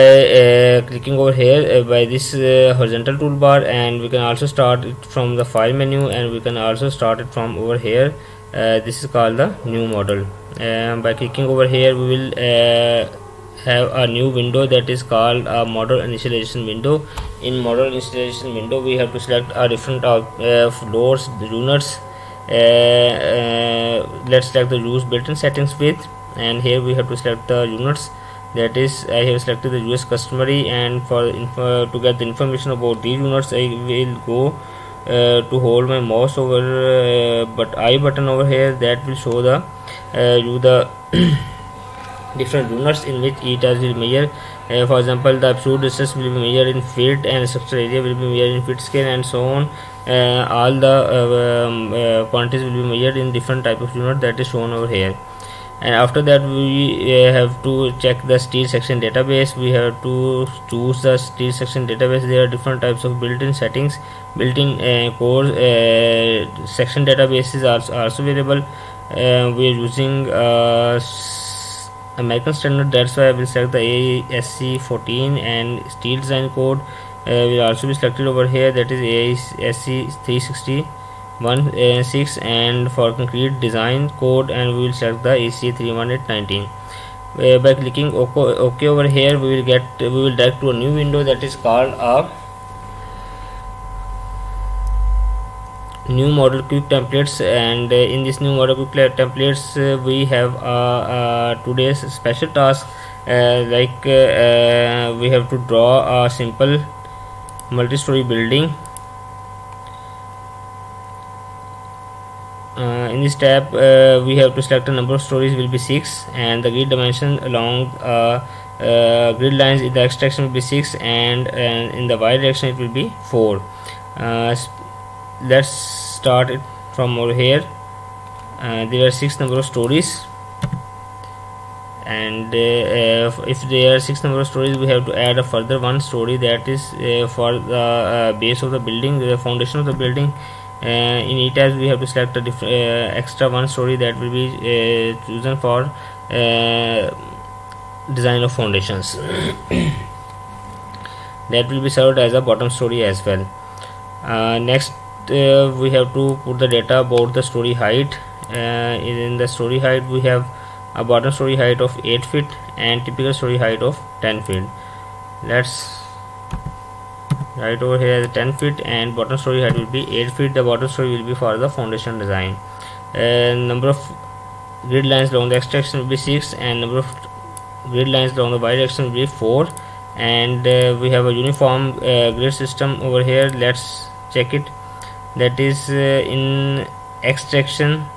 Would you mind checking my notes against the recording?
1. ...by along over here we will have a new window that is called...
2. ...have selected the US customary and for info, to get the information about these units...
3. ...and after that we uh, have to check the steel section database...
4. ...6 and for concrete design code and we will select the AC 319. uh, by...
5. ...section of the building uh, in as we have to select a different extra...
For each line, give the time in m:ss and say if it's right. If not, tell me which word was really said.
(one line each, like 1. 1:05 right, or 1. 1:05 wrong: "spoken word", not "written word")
1. 0:11 wrong: "clicking", not "along"
2. 0:29 right
3. 0:55 right
4. 1:22 right
5. 2:19 wrong: "foundation", not "section".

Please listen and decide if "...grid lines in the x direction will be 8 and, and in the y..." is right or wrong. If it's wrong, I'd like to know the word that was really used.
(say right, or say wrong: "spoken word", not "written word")
wrong: "6", not "8".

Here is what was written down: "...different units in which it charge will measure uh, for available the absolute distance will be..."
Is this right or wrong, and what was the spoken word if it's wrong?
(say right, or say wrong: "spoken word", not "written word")
wrong: "example", not "available".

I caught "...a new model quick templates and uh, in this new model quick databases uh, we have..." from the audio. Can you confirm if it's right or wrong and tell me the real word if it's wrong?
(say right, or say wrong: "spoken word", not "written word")
wrong: "templates", not "databases".